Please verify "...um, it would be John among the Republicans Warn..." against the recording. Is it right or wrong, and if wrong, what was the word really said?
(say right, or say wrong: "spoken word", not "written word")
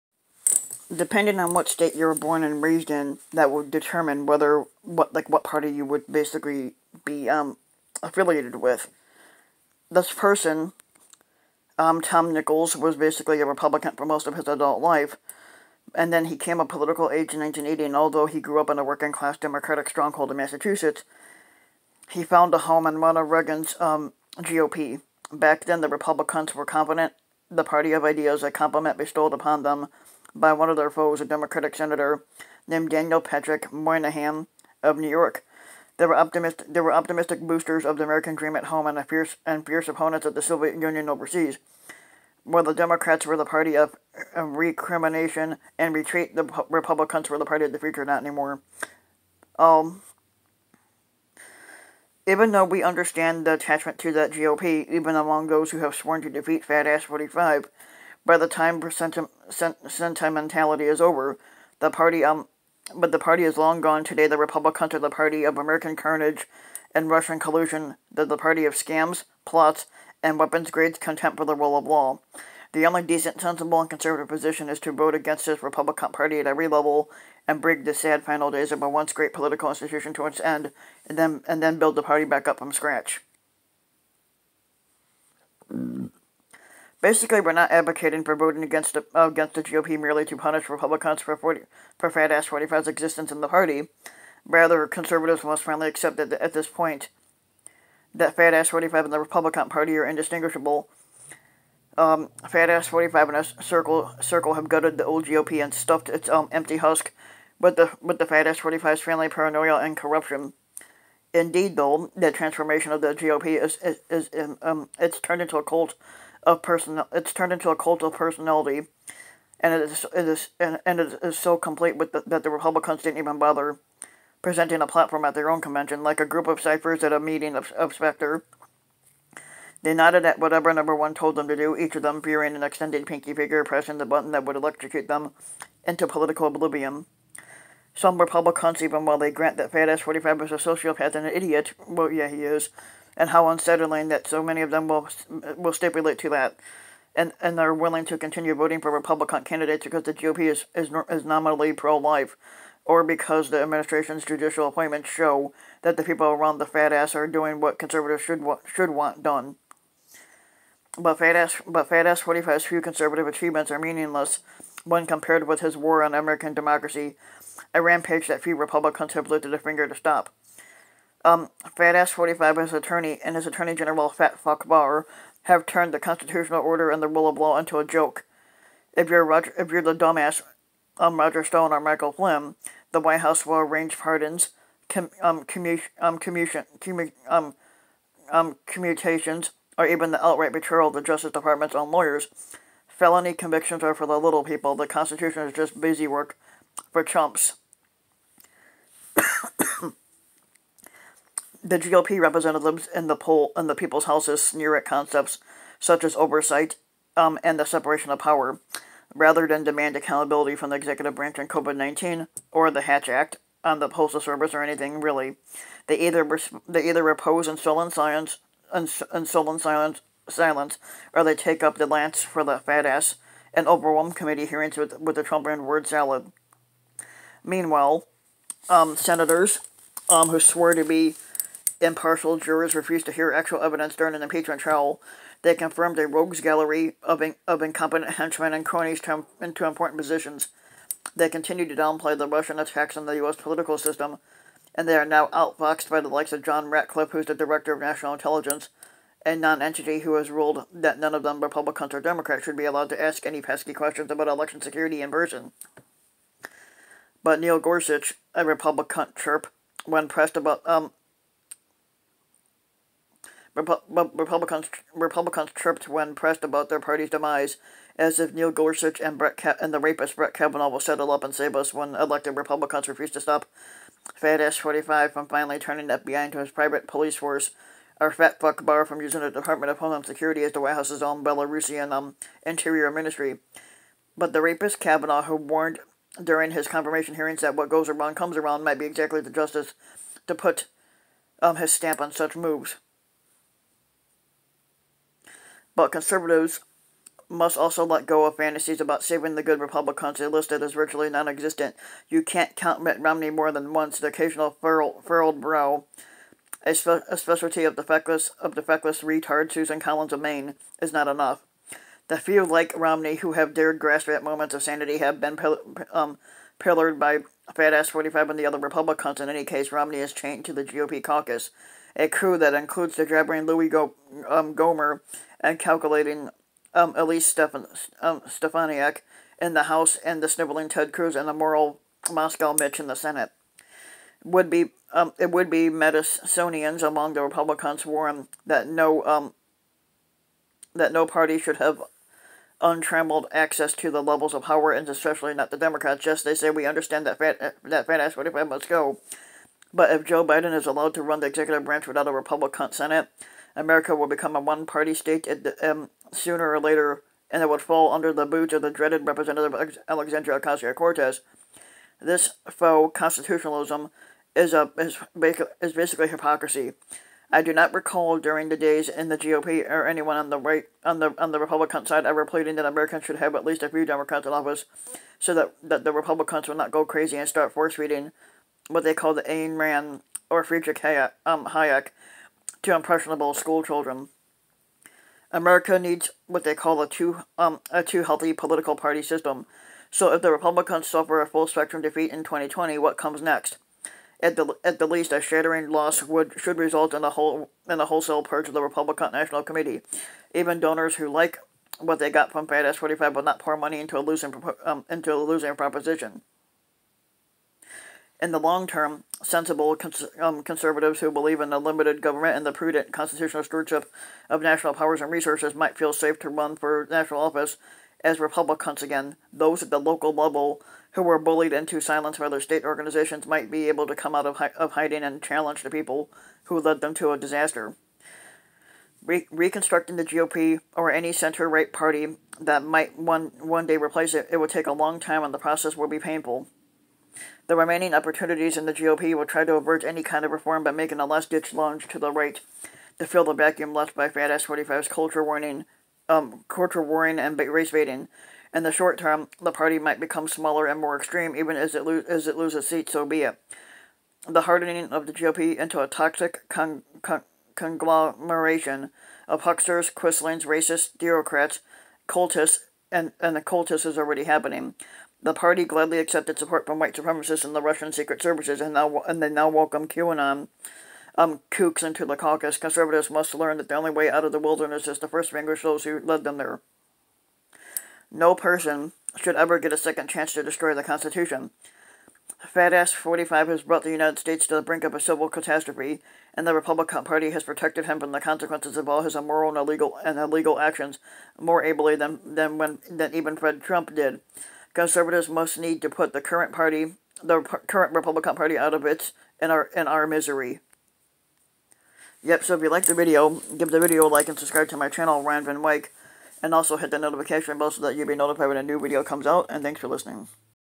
wrong: "Madisonians", not "John".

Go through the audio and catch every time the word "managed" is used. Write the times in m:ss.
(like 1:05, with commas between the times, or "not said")
not said.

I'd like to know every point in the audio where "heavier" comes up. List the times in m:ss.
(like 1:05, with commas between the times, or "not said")
not said.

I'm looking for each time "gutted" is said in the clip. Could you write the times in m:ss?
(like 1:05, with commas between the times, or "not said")
1:44.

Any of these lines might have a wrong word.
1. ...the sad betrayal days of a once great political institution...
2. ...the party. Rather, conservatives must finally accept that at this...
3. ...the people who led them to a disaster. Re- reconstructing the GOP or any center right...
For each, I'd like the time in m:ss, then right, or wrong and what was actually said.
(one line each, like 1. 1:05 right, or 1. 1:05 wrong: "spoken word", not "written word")
1. 1:17 wrong: "final", not "betrayal"
2. 1:33 right
3. 7:05 right.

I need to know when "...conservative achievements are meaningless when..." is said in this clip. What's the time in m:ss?
2:42.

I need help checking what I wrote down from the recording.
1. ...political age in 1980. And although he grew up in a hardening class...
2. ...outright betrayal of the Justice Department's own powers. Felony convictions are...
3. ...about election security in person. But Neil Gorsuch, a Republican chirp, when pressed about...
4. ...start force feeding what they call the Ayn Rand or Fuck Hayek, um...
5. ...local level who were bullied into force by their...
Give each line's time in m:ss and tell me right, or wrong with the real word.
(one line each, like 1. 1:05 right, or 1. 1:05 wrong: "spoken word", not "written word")
1. 0:16 wrong: "working", not "hardening"
2. 3:10 wrong: "lawyers", not "powers"
3. 4:14 right
4. 6:17 wrong: "Friedrich", not "Fuck"
5. 6:59 wrong: "silence", not "force".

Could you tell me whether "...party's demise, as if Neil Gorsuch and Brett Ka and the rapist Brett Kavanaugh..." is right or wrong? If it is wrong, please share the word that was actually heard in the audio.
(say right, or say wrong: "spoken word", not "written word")
right.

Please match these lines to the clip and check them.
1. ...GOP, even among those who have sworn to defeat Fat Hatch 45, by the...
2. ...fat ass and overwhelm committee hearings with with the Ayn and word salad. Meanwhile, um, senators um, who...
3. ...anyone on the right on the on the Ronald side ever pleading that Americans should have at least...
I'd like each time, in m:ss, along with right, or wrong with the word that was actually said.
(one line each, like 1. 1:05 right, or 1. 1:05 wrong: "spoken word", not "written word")
1. 0:54 wrong: "Ass", not "Hatch"
2. 3:42 wrong: "Trump", not "Ayn"
3. 6:09 wrong: "Republican", not "Ronald".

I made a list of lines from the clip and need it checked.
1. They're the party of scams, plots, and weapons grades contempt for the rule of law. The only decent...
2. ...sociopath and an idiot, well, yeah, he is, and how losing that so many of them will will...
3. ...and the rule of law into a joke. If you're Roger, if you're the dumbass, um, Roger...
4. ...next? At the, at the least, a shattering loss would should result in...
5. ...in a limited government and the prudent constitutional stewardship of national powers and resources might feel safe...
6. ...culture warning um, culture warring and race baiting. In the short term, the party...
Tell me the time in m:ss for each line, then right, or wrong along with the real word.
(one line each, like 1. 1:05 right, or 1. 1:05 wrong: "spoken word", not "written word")
1. 1:08 right
2. 2:20 wrong: "unsettling", not "losing"
3. 2:56 right
4. 6:33 right
5. 6:51 right
6. 7:24 right.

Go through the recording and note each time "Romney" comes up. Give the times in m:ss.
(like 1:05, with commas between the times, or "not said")
5:02, 5:12, 5:19.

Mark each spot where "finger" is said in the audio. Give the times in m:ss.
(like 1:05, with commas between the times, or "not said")
2:13, 2:49.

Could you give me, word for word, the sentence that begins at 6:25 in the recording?
America needs what they call a two um a two healthy political party system.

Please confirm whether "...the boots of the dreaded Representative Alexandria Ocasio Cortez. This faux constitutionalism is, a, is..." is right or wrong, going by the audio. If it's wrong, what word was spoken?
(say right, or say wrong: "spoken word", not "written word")
right.